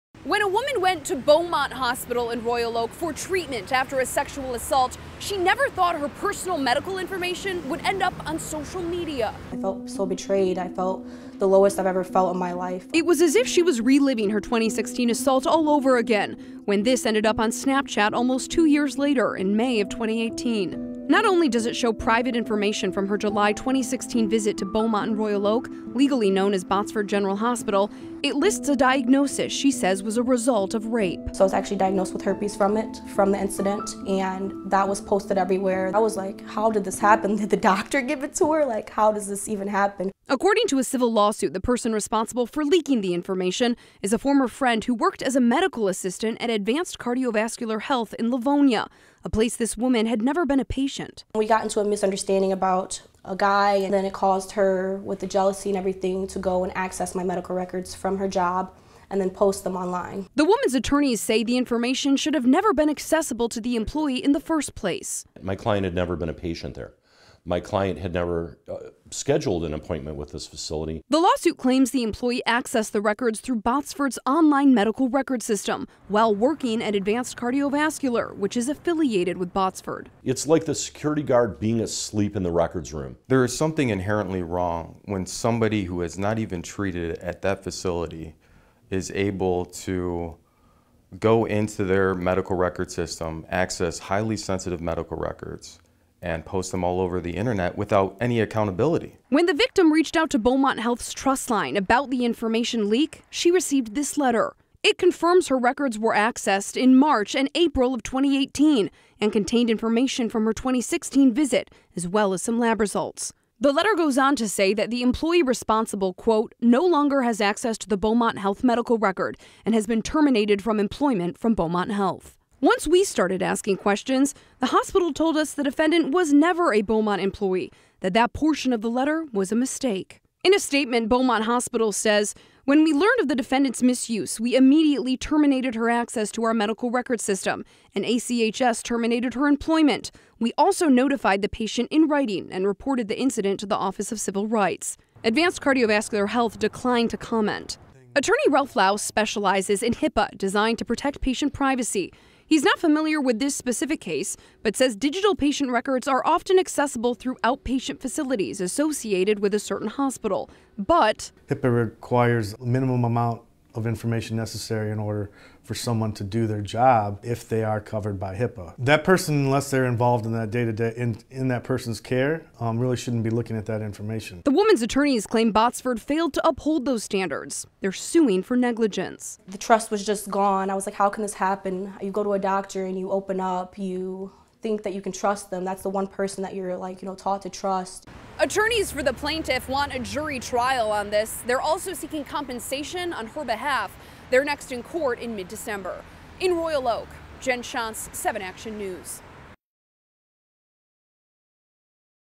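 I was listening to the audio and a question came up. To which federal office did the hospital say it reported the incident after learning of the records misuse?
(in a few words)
Office of Civil Rights.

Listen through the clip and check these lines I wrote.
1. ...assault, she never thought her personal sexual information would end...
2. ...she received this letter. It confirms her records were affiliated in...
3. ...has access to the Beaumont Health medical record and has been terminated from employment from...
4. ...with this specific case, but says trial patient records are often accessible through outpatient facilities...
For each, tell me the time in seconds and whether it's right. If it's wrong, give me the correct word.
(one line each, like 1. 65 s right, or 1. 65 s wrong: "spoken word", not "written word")
1. 4 s wrong: "medical", not "sexual"
2. 103 s wrong: "accessed", not "affiliated"
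3. 117 s right
4. 153 s wrong: "digital", not "trial".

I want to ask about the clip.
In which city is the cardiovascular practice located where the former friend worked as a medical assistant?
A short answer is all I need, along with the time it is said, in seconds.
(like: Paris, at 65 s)
Livonia, at 48 s.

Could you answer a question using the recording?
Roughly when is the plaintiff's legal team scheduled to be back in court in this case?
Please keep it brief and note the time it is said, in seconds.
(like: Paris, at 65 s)
mid-December, at 195 s.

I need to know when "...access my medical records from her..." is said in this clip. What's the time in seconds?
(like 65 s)
56 s.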